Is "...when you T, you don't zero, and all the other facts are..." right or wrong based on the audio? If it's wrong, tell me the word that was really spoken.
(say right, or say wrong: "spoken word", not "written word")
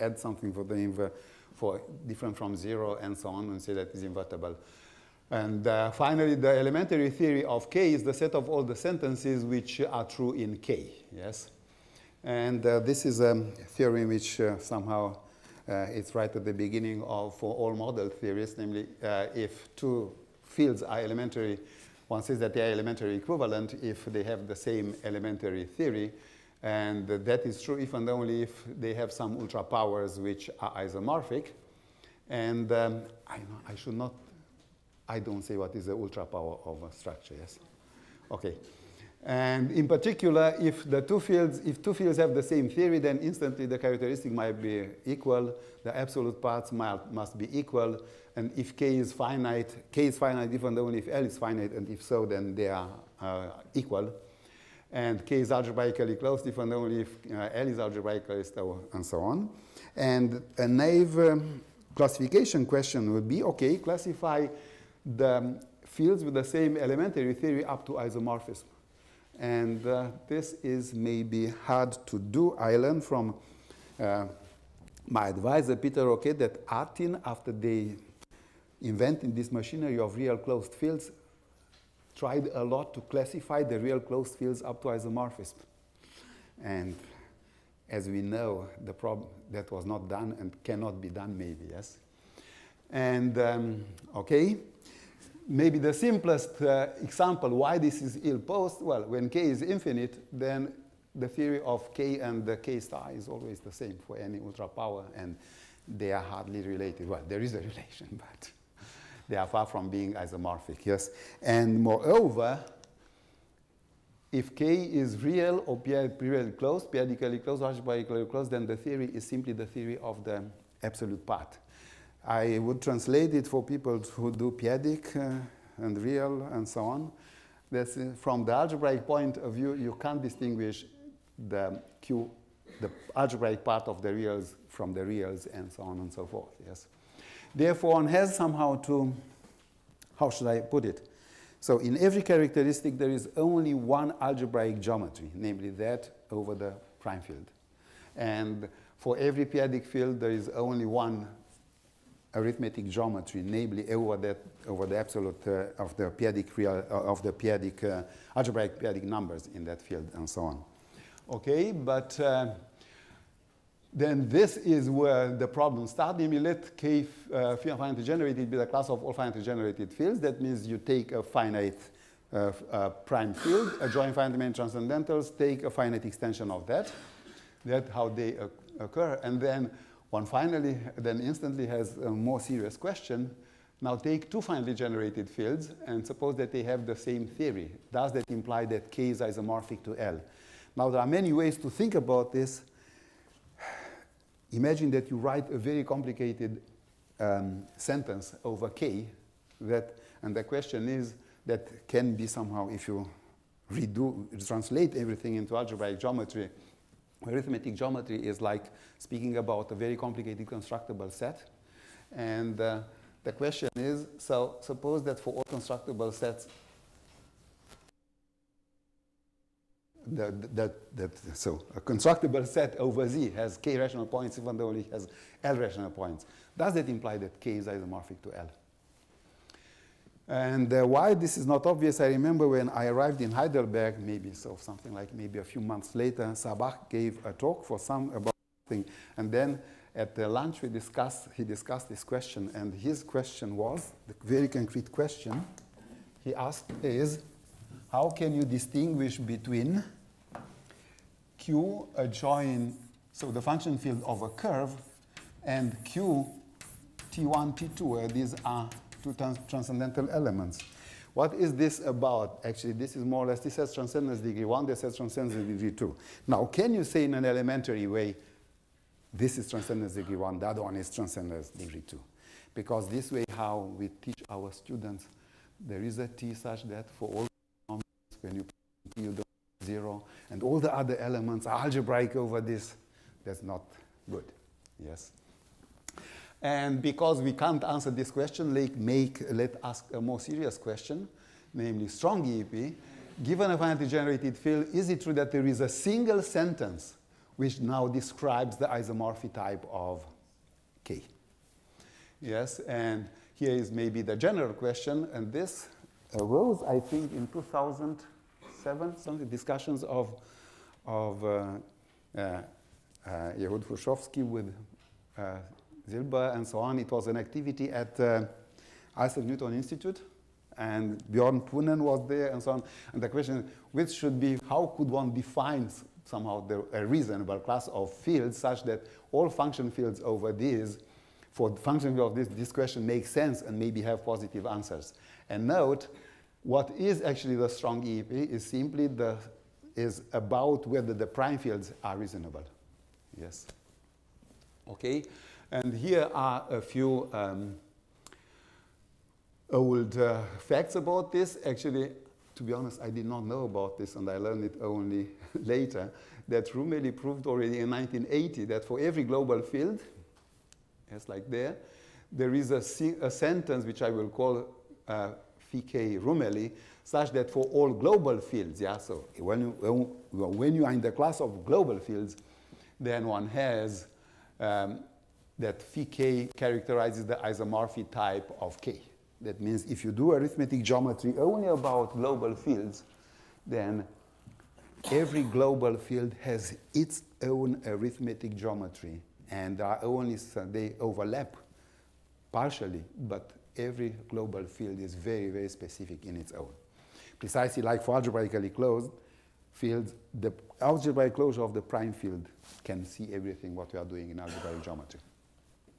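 wrong: "elements", not "facts".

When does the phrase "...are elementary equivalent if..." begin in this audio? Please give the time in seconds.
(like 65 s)
22 s.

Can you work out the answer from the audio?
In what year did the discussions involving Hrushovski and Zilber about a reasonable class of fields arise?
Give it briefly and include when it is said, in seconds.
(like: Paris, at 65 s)
2007, at 307 s.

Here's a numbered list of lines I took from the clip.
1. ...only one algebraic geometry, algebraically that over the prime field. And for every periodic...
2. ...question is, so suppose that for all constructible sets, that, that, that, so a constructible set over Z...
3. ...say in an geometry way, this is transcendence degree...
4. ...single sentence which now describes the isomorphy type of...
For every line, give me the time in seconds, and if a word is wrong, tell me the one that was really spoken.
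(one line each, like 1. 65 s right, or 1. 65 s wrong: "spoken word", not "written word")
1. 143 s wrong: "namely", not "algebraically"
2. 213 s right
3. 266 s wrong: "elementary", not "geometry"
4. 295 s right.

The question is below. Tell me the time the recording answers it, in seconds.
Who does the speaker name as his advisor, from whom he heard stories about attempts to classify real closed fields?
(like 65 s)
75 s.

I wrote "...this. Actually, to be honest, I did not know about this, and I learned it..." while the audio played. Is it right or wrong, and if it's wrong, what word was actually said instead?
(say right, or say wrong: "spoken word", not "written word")
right.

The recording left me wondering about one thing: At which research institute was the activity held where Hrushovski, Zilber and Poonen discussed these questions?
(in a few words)
Isaac Newton Institute.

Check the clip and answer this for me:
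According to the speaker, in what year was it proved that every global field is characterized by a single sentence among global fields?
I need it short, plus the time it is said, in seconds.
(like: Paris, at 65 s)
1980, at 357 s.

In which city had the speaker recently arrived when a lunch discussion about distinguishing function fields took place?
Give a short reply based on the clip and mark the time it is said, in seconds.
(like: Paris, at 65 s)
Heidelberg, at 233 s.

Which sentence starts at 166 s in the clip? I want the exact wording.
You let K uh, finitely generated be the class of all finitely generated fields.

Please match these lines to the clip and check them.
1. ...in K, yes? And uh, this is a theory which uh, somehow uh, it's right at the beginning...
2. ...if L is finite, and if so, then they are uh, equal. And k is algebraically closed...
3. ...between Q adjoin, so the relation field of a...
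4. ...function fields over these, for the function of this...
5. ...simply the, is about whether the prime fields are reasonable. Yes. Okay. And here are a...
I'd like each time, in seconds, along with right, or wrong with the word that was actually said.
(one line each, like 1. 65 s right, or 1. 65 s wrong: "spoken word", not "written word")
1. 10 s right
2. 50 s right
3. 249 s wrong: "function", not "relation"
4. 329 s right
5. 338 s right.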